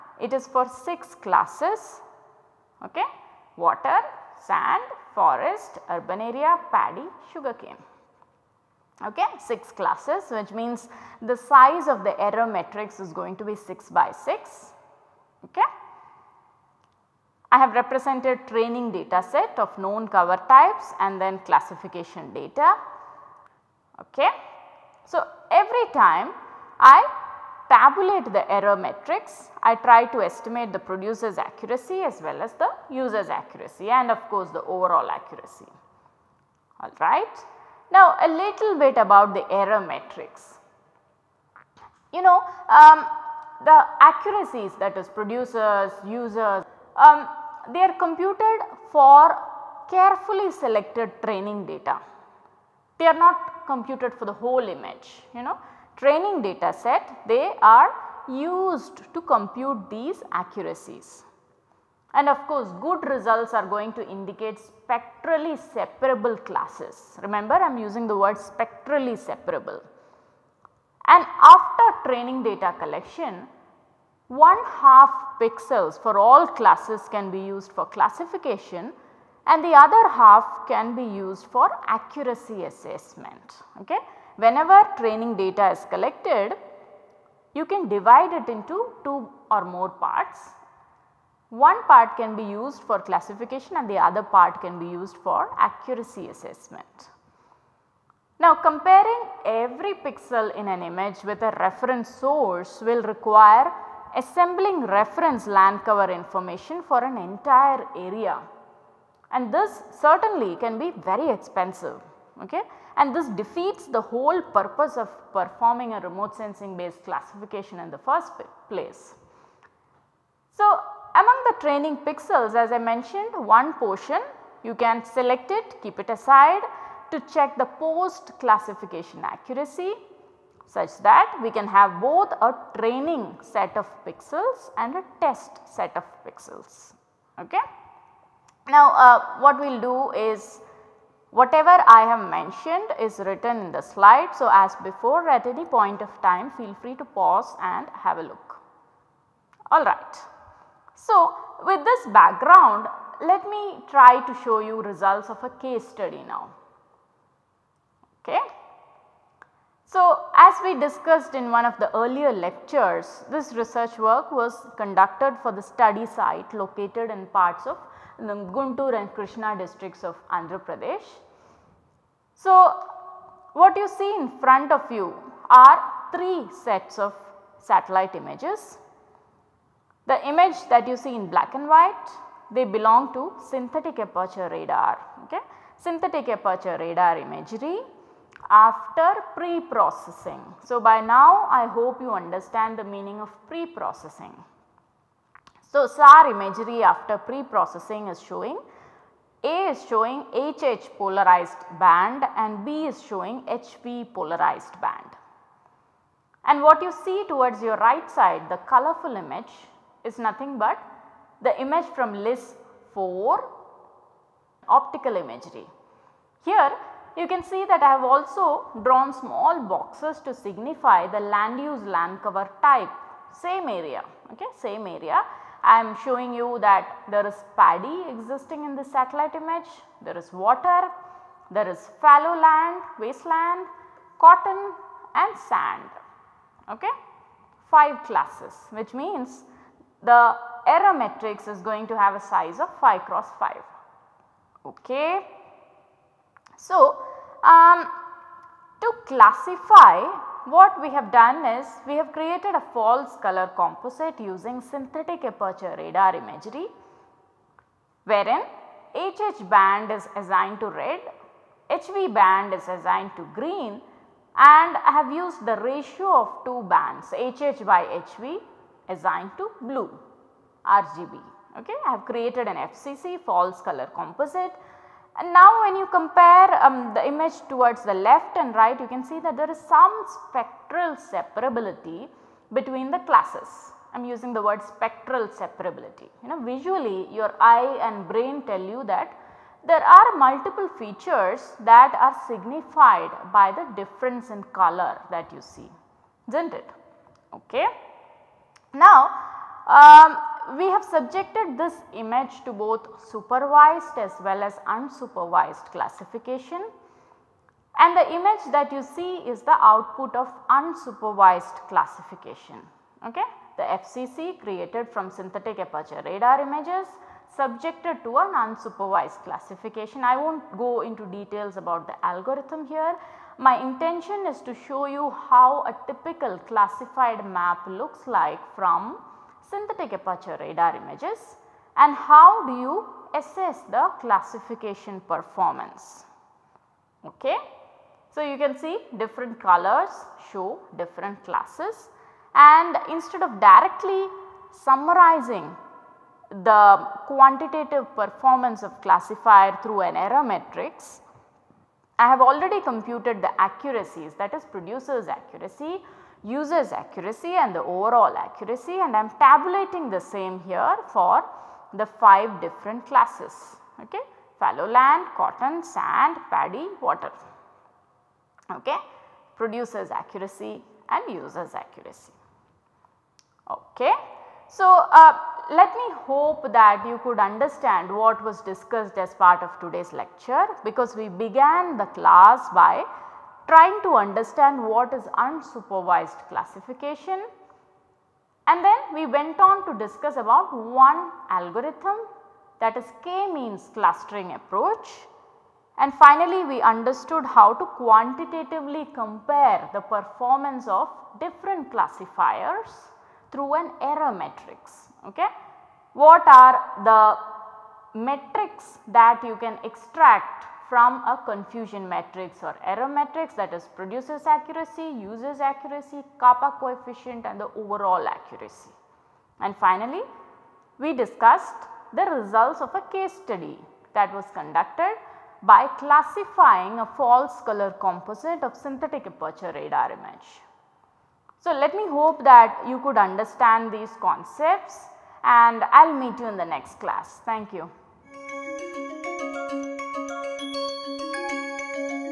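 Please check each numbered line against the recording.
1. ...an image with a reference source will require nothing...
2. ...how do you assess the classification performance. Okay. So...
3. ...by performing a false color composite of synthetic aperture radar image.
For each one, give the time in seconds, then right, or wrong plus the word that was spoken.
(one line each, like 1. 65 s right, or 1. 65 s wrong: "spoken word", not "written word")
1. 100 s wrong: "assembling", not "nothing"
2. 331 s right
3. 425 s wrong: "classifying", not "performing".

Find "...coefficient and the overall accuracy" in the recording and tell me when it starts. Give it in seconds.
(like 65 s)
416 s.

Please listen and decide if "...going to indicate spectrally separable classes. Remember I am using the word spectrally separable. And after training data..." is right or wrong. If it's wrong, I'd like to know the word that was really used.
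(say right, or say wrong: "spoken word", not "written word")
right.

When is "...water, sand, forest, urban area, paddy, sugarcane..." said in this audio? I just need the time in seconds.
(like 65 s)
3 s.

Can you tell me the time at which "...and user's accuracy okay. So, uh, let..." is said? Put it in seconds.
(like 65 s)
370 s.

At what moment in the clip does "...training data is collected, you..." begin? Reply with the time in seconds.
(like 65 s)
84 s.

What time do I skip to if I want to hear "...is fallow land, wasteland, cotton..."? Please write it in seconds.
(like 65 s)
231 s.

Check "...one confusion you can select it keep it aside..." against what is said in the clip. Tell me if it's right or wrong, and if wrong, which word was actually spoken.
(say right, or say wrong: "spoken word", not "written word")
wrong: "portion", not "confusion".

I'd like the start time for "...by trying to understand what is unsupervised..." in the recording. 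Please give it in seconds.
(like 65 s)
382 s.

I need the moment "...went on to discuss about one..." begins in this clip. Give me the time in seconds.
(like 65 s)
389 s.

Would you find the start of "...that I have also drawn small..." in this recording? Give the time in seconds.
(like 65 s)
217 s.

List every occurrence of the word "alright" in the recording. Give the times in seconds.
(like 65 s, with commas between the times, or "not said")
36 s, 149 s.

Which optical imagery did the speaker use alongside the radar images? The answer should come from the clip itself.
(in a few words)
LISS 4.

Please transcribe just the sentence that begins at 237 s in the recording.
5 classes which means the error matrix is going to have a size of 5 cross 5.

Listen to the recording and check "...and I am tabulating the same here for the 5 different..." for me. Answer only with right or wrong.
right.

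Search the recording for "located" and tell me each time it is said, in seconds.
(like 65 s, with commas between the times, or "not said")
166 s.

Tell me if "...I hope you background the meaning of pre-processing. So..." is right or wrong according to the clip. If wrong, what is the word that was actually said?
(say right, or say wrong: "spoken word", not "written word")
wrong: "understand", not "background".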